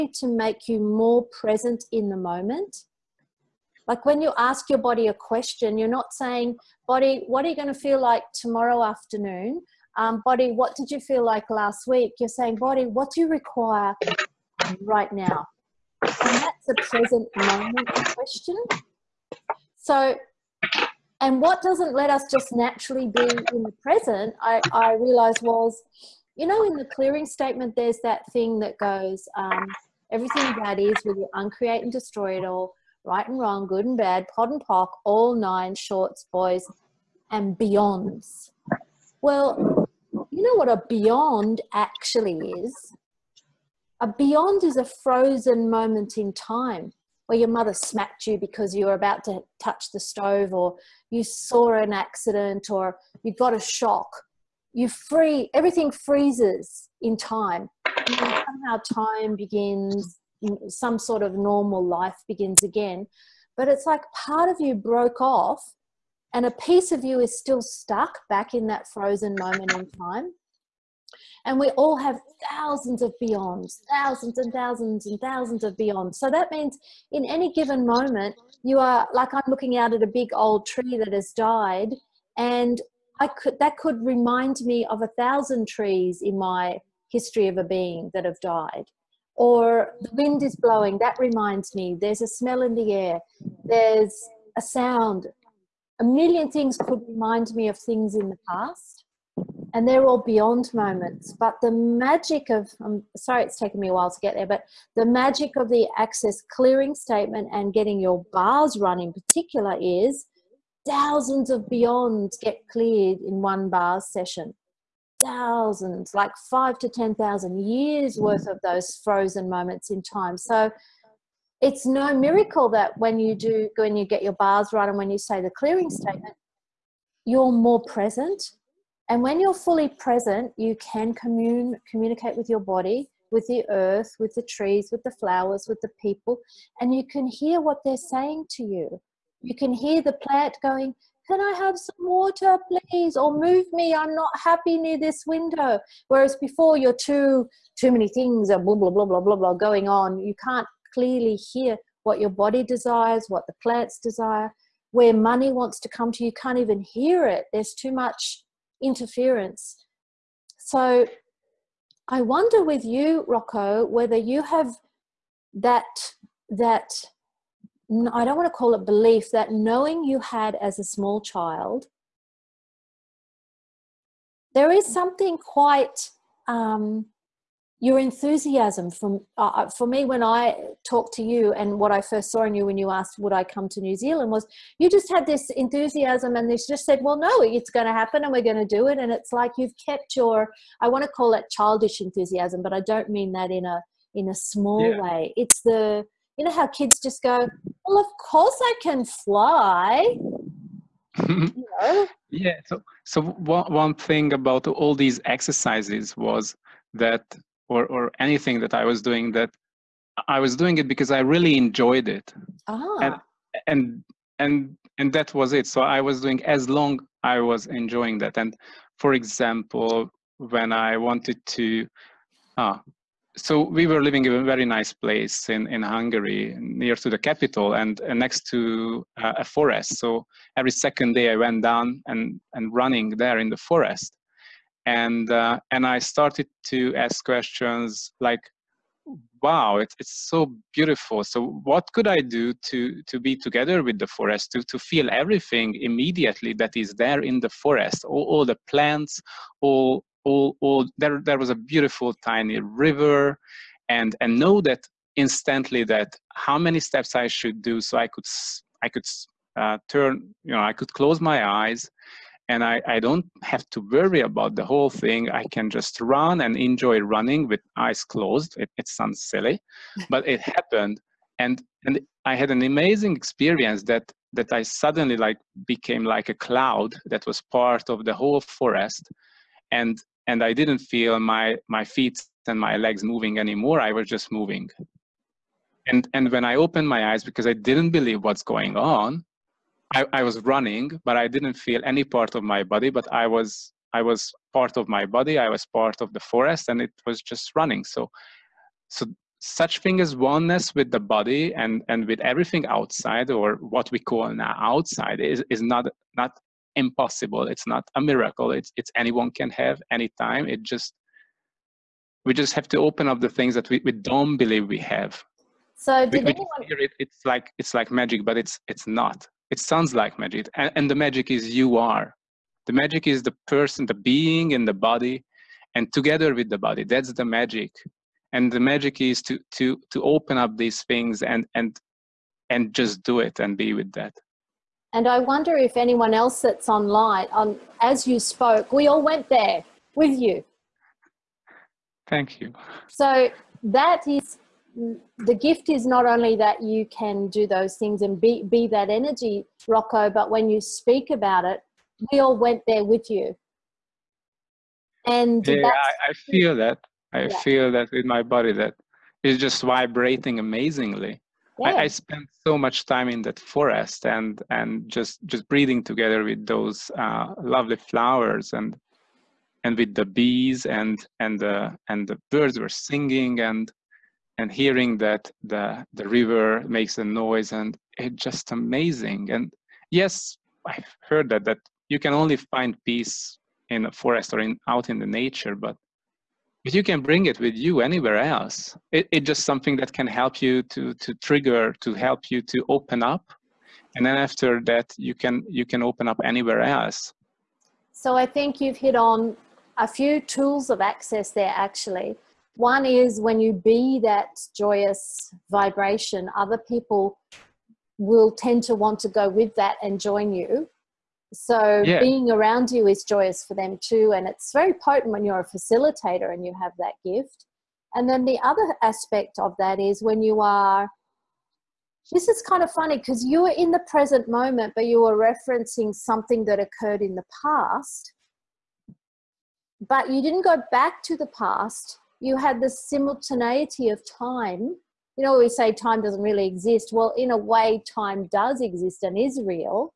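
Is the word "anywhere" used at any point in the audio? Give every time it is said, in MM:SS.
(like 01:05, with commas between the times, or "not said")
06:27, 06:36.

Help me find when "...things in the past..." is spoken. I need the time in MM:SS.
01:37.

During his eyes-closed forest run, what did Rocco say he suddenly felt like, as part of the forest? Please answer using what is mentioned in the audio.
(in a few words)
A cloud.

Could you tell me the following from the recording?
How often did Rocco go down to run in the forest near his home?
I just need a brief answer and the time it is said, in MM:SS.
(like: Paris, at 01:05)
Every second day, at 03:50.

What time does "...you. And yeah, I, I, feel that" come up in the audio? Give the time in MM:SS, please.
05:53.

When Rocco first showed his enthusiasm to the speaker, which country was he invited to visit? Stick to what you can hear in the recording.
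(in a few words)
New Zealand.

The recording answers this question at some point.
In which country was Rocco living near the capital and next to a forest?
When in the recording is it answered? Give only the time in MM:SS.
03:45.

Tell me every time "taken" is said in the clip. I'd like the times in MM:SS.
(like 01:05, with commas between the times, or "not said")
01:43.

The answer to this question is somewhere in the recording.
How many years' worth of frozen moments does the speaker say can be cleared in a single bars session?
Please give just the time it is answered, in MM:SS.
01:56.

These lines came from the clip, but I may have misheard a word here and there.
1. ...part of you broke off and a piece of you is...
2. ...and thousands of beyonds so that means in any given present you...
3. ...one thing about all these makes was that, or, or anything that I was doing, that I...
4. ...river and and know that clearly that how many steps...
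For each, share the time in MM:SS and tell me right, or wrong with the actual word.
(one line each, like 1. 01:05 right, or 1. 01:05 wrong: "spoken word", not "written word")
1. 01:04 right
2. 01:15 wrong: "moment", not "present"
3. 03:23 wrong: "exercises", not "makes"
4. 04:12 wrong: "instantly", not "clearly".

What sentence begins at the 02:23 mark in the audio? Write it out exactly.
Or move me, I'm not happy near this window.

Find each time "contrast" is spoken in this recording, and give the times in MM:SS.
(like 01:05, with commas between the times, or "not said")
not said.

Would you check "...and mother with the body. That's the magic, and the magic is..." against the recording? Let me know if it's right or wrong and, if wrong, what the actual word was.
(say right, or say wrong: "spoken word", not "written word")
wrong: "together", not "mother".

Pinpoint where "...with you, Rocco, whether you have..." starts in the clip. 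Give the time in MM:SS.
02:42.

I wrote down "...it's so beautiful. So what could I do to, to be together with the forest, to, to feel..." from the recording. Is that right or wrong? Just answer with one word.
right.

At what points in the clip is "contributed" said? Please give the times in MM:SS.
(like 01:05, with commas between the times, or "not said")
not said.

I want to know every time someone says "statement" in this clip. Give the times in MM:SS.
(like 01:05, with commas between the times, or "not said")
00:27, 01:46, 02:05.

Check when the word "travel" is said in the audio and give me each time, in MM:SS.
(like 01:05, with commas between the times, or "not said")
not said.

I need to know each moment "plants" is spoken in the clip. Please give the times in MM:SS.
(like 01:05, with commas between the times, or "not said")
02:20, 02:33, 04:08.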